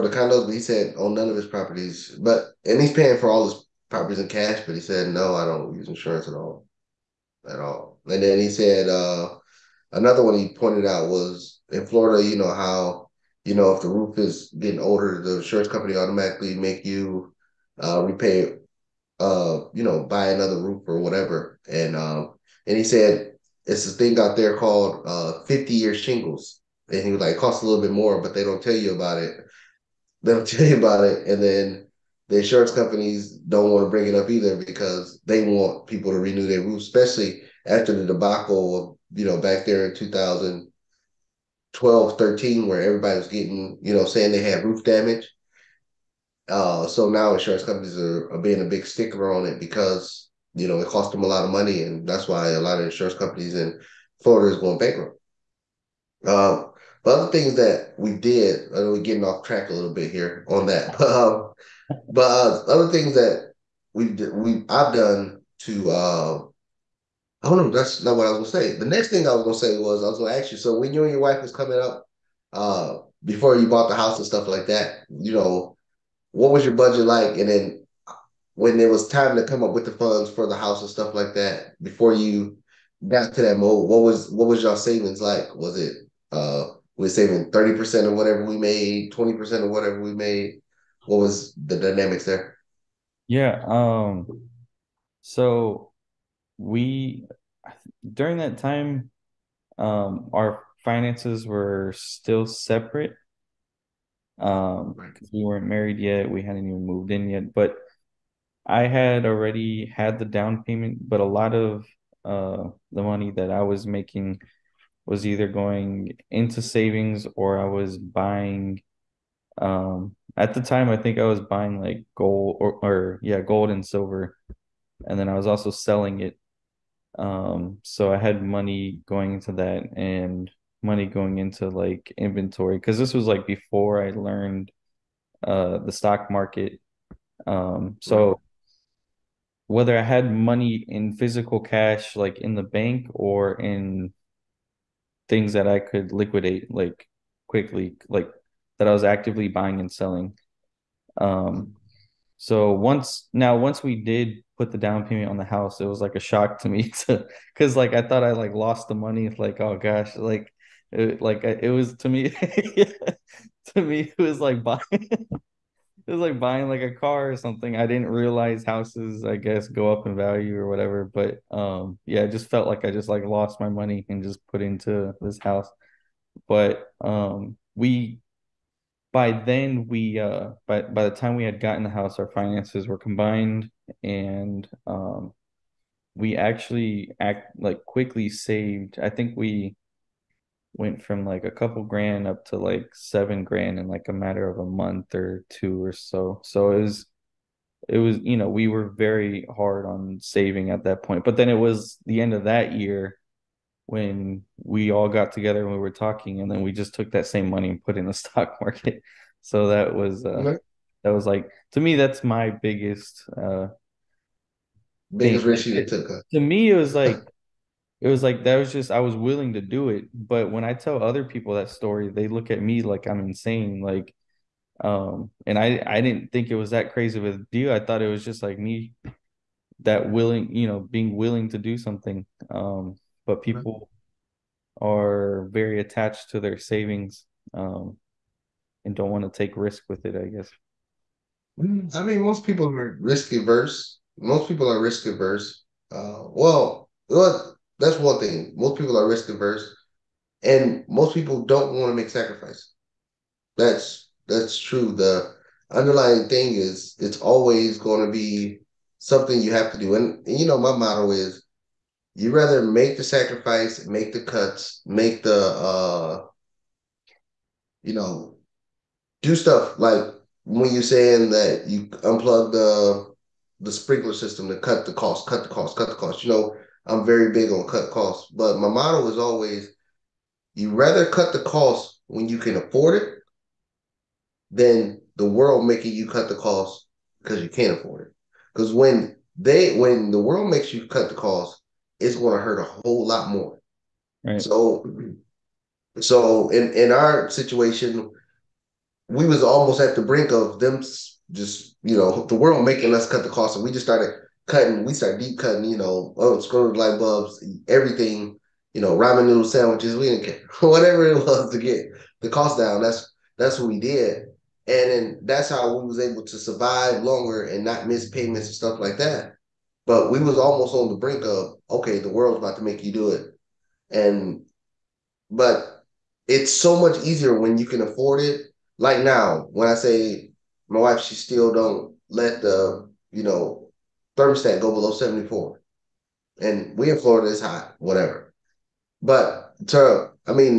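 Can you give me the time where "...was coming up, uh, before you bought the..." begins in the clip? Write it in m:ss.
1:11.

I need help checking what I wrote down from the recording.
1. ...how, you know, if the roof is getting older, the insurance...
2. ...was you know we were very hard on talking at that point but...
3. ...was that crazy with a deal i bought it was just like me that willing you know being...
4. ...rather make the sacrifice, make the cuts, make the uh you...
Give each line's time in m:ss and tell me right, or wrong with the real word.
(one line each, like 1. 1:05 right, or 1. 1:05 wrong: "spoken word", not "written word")
1. 0:12 right
2. 3:17 wrong: "saving", not "talking"
3. 3:46 wrong: "thought", not "bought"
4. 4:22 right.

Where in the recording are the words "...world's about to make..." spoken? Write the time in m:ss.
5:22.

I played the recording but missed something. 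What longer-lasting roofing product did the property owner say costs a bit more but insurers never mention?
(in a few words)
50 year shingles.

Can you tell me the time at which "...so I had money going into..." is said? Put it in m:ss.
2:07.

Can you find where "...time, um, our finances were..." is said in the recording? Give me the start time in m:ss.
1:38.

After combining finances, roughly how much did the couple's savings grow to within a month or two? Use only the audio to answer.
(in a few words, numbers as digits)
7 grand.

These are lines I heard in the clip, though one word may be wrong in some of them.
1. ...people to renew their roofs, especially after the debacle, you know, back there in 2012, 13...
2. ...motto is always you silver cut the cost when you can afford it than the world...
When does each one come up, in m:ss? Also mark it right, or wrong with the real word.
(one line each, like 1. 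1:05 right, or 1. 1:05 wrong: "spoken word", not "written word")
1. 0:35 right
2. 4:38 wrong: "rather", not "silver".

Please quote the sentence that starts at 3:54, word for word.
are very attached to their savings um, and don't want to take risk with it.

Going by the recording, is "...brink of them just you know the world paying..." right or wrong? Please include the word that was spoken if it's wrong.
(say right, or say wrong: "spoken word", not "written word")
wrong: "making", not "paying".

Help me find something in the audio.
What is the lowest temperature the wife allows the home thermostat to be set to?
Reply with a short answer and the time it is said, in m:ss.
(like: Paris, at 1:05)
74, at 5:34.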